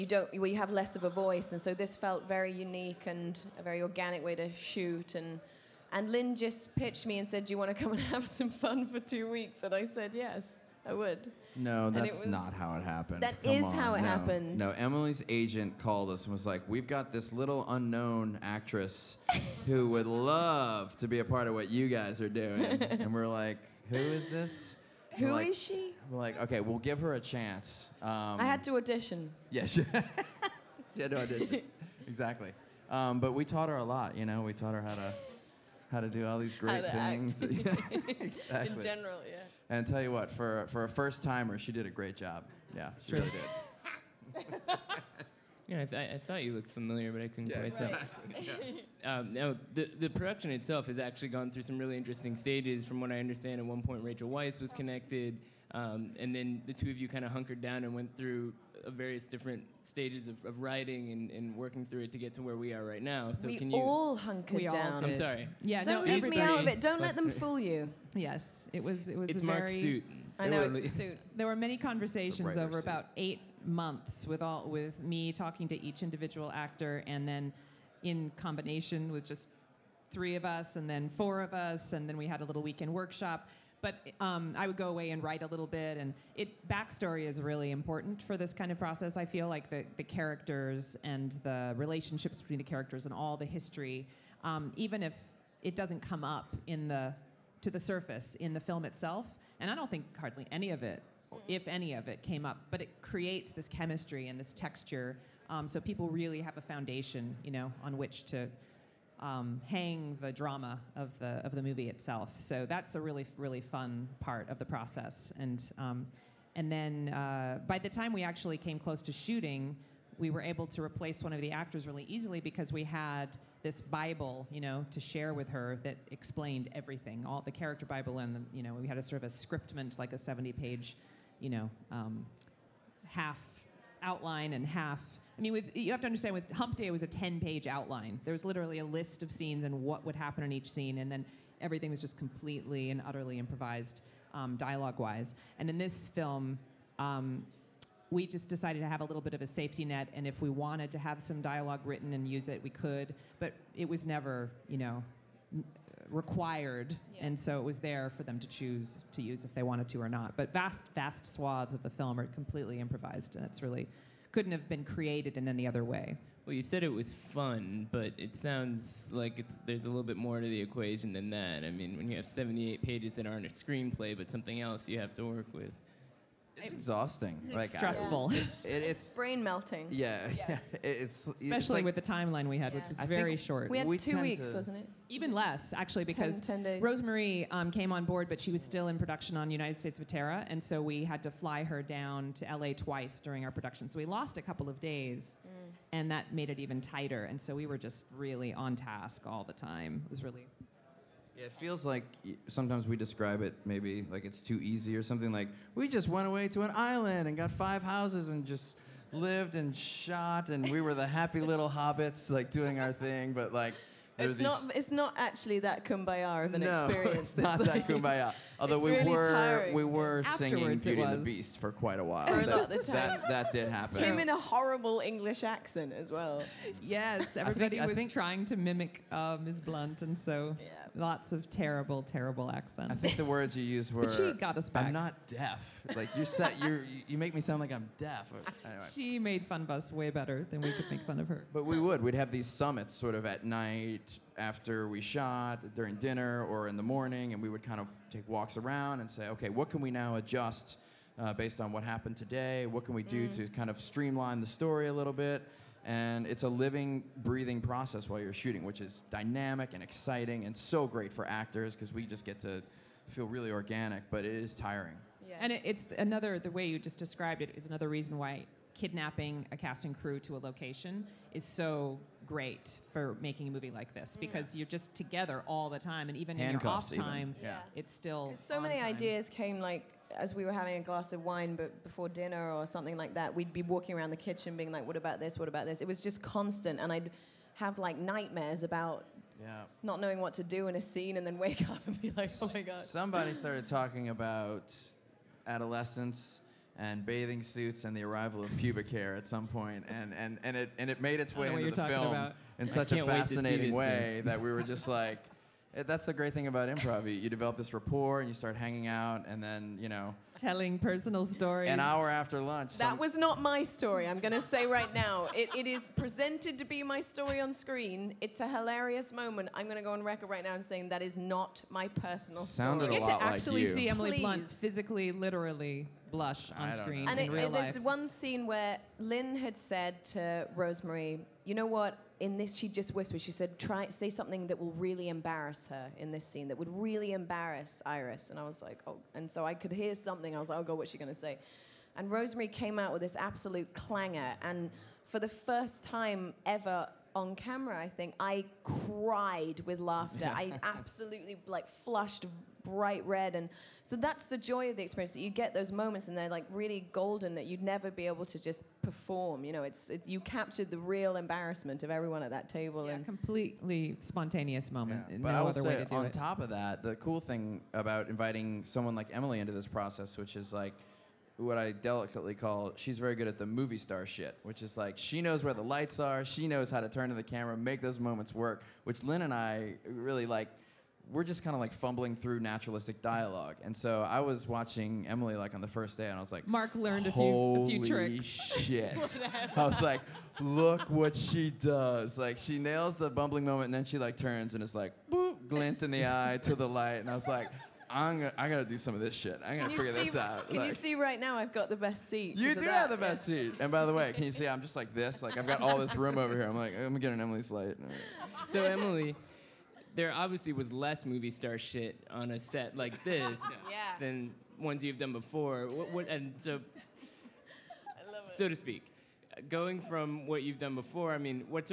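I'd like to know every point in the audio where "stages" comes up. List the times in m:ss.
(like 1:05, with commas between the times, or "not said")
0:52, 0:59.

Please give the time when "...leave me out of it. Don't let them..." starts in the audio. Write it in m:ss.
1:06.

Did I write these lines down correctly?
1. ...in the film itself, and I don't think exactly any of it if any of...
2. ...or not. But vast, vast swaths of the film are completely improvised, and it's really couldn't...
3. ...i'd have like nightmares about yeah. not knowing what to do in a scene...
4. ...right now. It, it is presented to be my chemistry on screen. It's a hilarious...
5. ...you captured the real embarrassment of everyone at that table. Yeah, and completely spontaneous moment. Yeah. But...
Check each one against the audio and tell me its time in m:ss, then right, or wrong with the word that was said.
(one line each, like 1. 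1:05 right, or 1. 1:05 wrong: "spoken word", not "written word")
1. 1:38 wrong: "hardly", not "exactly"
2. 2:40 right
3. 4:46 right
4. 5:14 wrong: "story", not "chemistry"
5. 6:00 right.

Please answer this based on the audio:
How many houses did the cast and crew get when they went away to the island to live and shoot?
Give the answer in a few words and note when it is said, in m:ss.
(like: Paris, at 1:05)
5, at 3:27.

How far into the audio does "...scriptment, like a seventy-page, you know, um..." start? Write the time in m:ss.
2:09.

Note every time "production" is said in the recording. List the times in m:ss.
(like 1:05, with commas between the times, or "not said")
0:50, 3:08, 3:13.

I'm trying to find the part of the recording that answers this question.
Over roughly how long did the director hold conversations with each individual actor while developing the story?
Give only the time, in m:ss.
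1:13.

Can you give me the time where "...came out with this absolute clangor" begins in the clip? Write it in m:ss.
5:42.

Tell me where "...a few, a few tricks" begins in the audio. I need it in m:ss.
6:27.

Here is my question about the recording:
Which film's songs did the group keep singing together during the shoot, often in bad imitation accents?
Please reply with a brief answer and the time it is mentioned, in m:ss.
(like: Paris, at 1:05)
Beauty and the Beast, at 3:40.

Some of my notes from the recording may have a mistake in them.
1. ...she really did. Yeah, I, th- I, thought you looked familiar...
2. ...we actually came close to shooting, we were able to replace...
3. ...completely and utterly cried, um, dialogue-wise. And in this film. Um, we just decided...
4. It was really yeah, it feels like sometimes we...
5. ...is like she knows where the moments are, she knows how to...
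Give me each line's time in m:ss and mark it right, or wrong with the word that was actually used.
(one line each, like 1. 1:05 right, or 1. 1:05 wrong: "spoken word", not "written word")
1. 0:43 right
2. 1:58 right
3. 2:22 wrong: "improvised", not "cried"
4. 3:20 right
5. 6:14 wrong: "lights", not "moments".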